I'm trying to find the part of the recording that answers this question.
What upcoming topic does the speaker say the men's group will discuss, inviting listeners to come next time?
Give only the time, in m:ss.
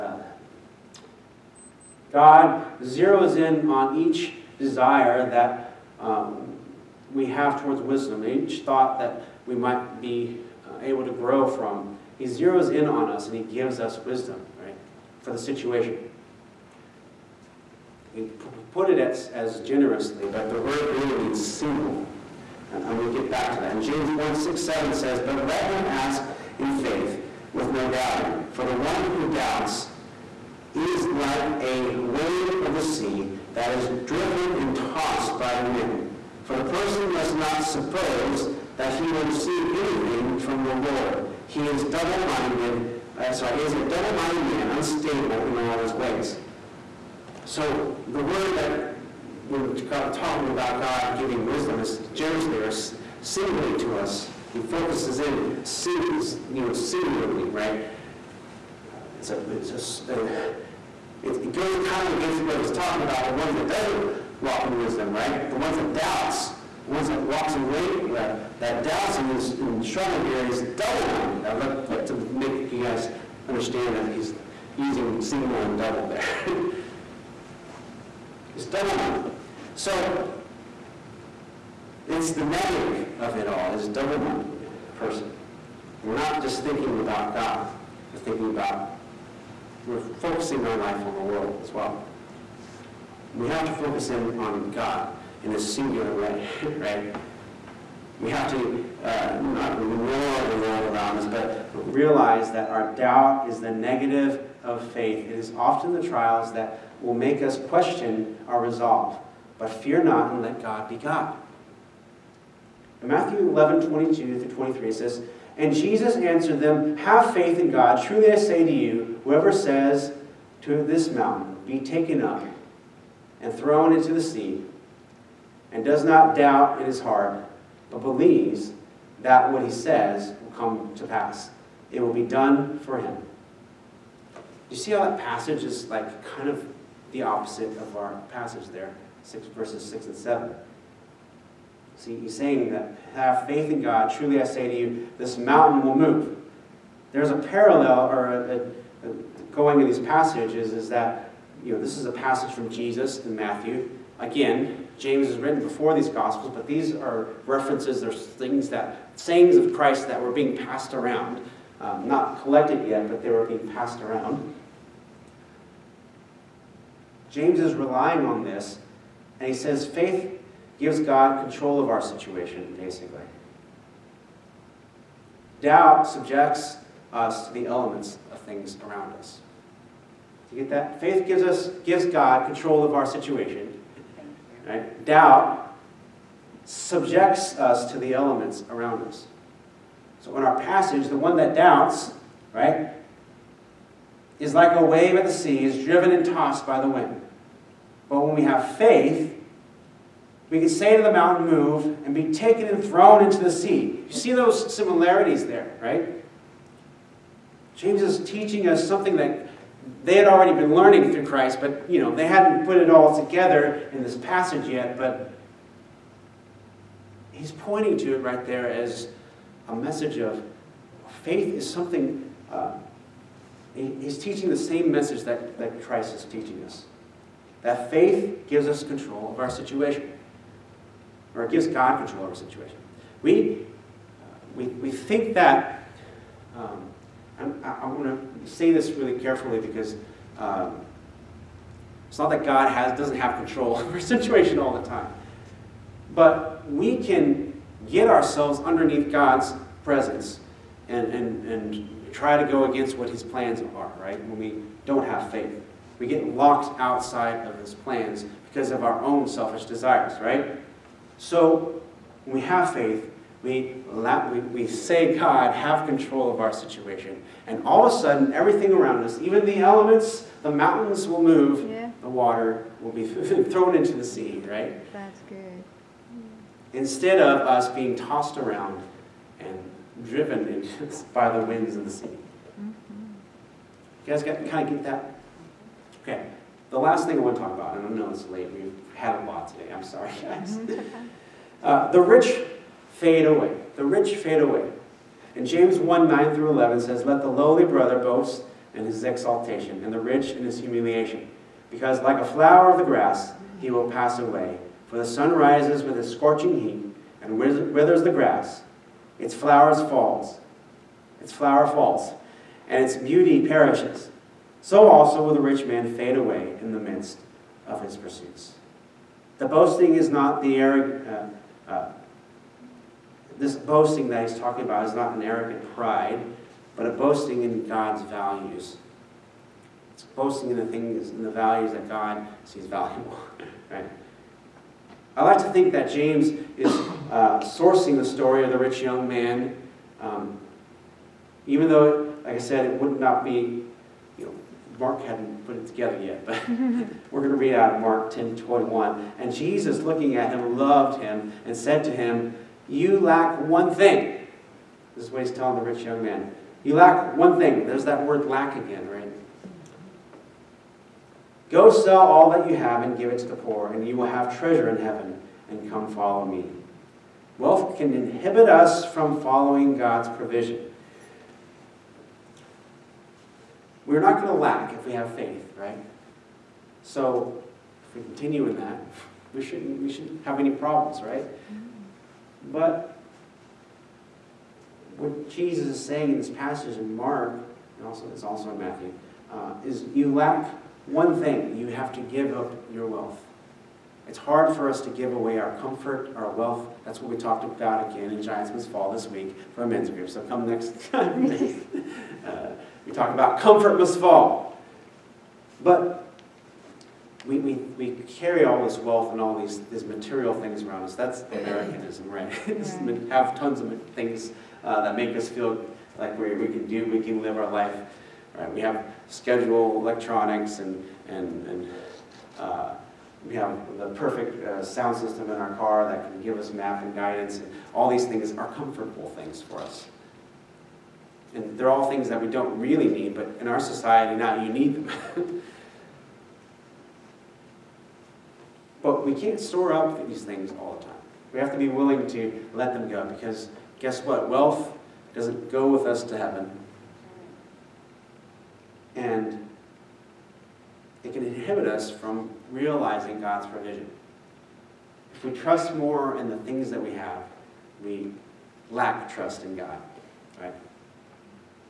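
6:43.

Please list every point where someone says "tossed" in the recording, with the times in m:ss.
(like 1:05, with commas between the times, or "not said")
0:34, 3:16, 4:37.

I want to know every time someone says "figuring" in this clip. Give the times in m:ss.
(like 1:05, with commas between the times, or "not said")
not said.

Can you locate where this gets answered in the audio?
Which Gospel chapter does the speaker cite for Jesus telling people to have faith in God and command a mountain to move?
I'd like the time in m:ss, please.
1:53.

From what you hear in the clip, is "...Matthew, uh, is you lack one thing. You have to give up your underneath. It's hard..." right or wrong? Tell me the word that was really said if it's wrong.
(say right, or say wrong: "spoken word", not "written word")
wrong: "wealth", not "underneath".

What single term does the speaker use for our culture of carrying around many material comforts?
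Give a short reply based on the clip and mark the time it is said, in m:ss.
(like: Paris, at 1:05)
Americanism, at 6:51.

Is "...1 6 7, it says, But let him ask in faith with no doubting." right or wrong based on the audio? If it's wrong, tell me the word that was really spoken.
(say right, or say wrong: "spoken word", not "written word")
right.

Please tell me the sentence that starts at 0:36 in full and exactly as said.
For the person must not suppose that he will receive anything from the Lord.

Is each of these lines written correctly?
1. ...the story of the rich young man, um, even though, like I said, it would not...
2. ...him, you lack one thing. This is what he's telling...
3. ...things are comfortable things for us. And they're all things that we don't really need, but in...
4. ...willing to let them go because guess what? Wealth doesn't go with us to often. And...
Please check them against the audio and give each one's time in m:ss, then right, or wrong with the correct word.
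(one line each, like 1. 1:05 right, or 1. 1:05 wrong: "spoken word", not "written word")
1. 5:37 right
2. 5:51 right
3. 7:08 right
4. 7:21 wrong: "heaven", not "often".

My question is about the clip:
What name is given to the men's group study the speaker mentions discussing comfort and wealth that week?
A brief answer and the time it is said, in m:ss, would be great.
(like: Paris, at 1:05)
Giants Must Fall, at 6:38.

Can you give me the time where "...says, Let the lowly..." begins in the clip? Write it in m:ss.
4:56.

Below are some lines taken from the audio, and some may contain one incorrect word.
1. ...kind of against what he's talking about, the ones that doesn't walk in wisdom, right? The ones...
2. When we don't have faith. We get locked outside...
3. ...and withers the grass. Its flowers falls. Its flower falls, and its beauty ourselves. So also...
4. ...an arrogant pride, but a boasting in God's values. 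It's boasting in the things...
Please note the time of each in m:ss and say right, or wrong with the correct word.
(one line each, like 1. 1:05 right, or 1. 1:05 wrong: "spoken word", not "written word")
1. 1:01 right
2. 4:14 right
3. 5:07 wrong: "perishes", not "ourselves"
4. 5:25 right.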